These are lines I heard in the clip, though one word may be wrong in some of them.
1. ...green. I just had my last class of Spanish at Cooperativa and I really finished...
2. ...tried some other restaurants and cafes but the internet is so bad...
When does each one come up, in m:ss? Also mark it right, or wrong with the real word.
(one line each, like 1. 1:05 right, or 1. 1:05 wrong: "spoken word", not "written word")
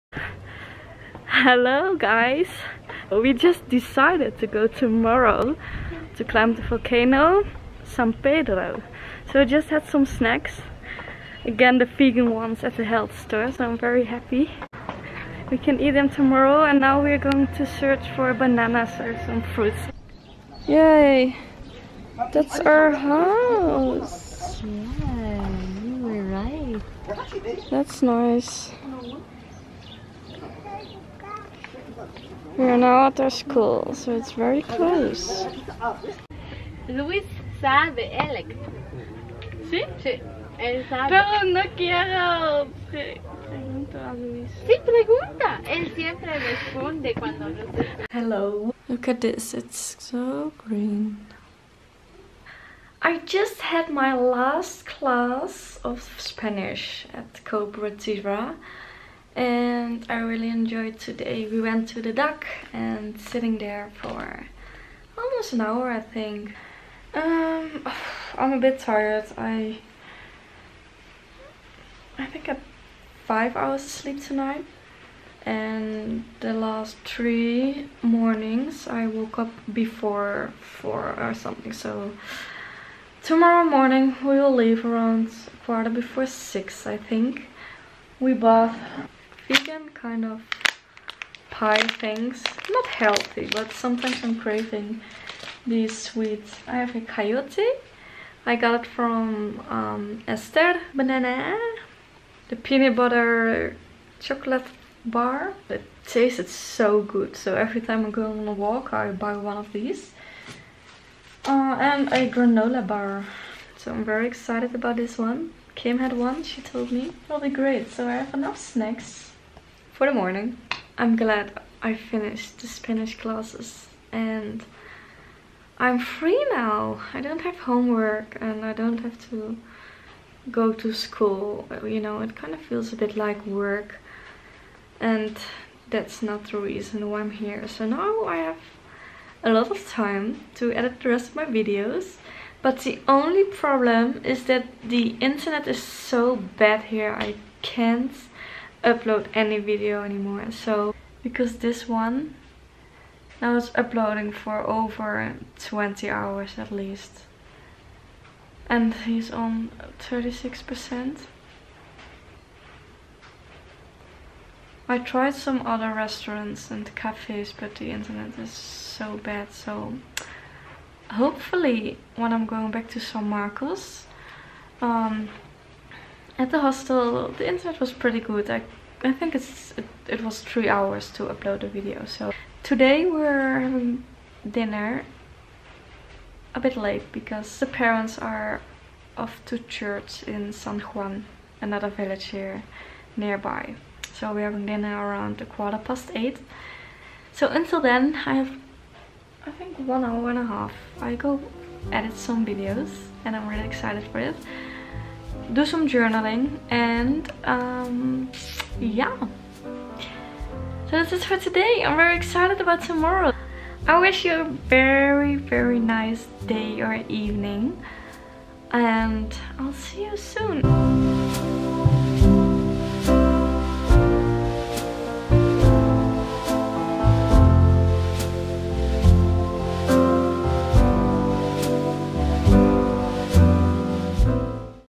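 1. 0:50 wrong: "enjoyed", not "finished"
2. 2:44 right.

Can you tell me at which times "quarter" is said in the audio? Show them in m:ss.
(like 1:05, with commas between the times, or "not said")
1:25, 3:15.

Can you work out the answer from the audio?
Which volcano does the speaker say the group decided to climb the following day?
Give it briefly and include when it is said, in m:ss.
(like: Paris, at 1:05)
San Pedro, at 0:07.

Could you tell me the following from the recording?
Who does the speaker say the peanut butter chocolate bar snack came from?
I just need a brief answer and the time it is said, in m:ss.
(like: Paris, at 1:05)
Esther Banana, at 1:40.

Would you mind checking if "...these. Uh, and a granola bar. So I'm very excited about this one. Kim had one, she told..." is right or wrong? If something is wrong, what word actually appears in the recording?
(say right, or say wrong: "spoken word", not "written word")
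right.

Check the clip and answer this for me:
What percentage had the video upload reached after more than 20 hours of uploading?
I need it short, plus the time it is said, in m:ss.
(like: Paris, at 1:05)
36%, at 2:39.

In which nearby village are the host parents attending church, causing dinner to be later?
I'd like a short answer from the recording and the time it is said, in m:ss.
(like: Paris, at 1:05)
San Juan, at 3:10.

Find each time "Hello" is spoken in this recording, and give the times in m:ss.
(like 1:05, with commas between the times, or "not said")
0:01, 0:48.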